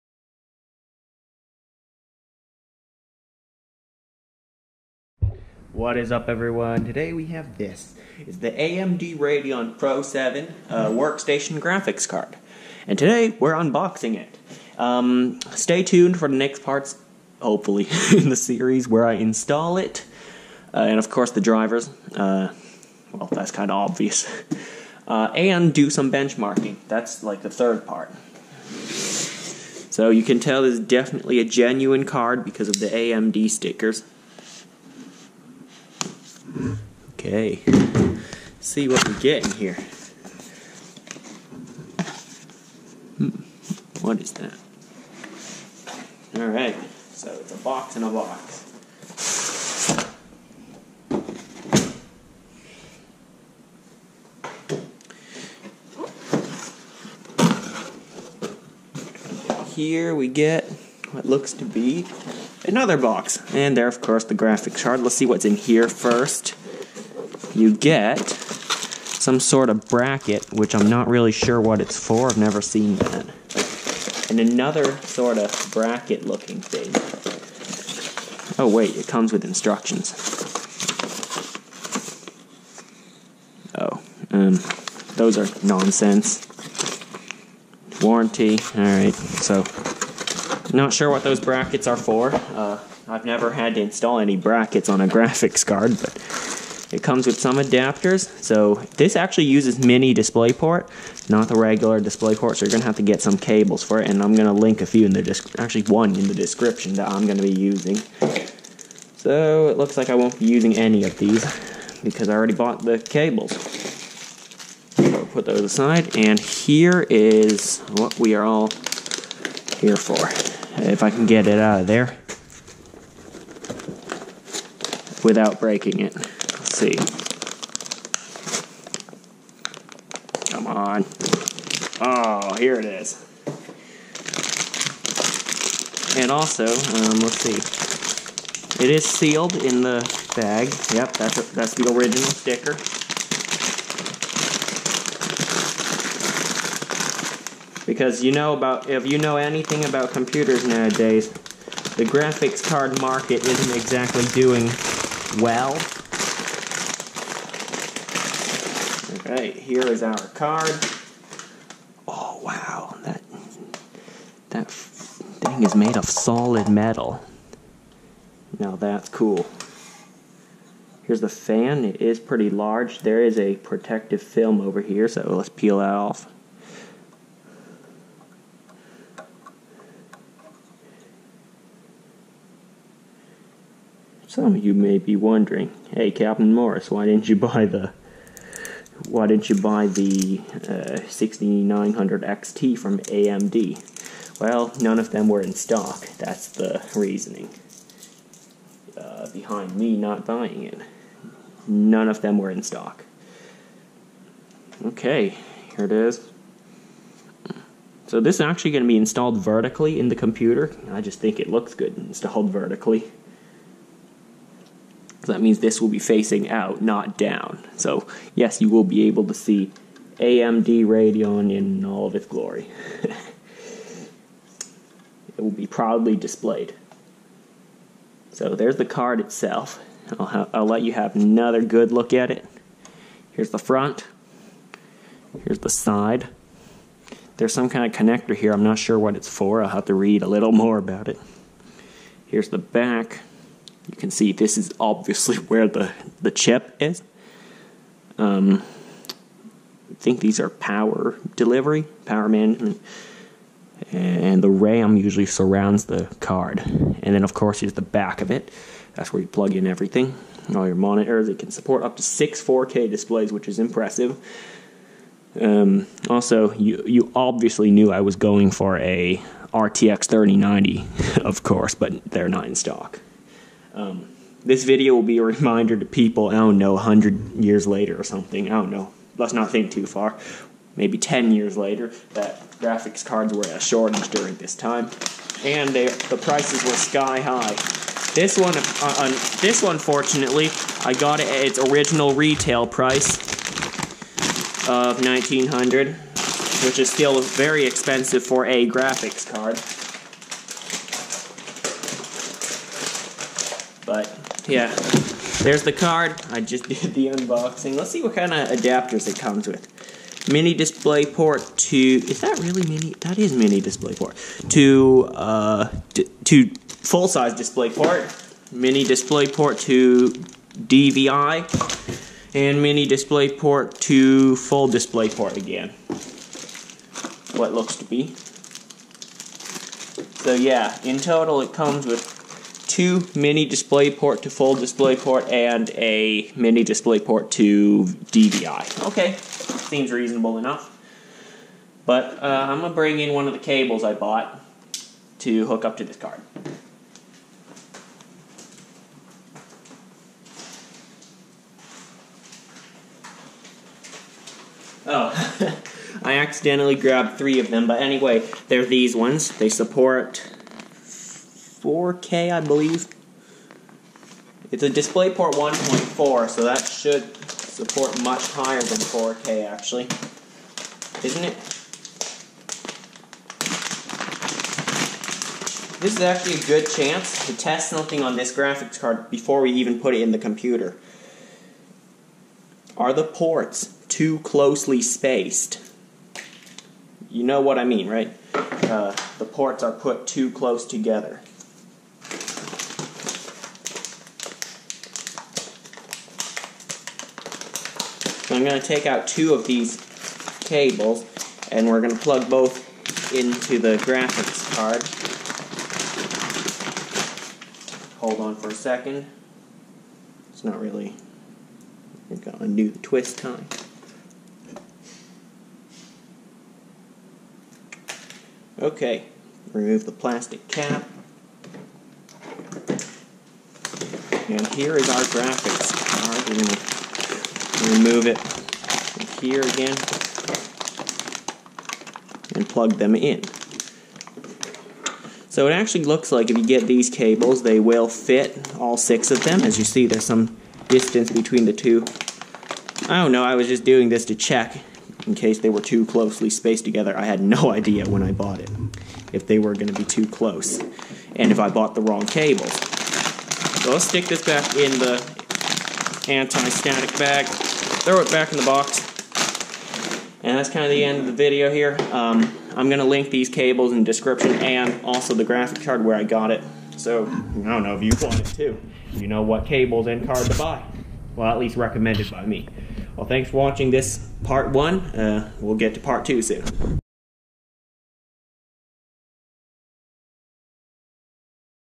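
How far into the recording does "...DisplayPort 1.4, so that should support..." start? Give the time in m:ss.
6:04.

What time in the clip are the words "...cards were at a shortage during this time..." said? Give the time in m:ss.
4:43.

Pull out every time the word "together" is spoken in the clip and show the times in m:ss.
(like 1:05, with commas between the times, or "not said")
6:30, 7:26.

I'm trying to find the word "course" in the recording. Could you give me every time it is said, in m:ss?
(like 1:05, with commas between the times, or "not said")
0:21, 1:04, 4:17, 4:31.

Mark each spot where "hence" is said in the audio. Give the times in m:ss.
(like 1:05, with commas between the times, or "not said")
not said.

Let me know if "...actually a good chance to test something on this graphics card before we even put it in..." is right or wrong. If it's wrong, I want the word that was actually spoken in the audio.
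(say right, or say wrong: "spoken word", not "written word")
right.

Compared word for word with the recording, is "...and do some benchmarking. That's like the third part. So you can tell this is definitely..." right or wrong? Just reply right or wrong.
right.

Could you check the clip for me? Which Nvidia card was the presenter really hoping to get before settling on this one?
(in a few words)
RTX 3090.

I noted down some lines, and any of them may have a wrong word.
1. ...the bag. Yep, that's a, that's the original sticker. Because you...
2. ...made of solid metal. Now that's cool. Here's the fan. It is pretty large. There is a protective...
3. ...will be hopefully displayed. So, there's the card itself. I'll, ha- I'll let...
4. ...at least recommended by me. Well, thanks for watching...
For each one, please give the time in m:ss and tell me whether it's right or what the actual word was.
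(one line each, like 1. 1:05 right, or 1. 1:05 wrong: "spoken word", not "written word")
1. 2:19 right
2. 2:45 right
3. 3:45 wrong: "proudly", not "hopefully"
4. 7:51 right.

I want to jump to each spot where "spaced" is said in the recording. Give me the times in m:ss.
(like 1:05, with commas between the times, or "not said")
6:24, 7:26.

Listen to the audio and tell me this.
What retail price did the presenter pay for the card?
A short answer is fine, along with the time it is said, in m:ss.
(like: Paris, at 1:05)
1900, at 4:55.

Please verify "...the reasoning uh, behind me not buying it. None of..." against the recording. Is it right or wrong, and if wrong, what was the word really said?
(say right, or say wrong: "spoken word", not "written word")
right.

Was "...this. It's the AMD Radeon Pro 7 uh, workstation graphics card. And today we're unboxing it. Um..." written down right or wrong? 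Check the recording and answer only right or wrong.
right.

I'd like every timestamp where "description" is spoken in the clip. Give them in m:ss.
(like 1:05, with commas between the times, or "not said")
1:46, 7:43.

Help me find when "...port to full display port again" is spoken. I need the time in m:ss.
5:23.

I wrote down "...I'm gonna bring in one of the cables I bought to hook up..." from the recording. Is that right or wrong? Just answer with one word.
right.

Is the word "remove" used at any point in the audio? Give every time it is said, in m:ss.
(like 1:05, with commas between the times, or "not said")
6:59, 7:07.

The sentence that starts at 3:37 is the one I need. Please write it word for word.
So, yes, you will be able to see AMD Radeon in all of its glory.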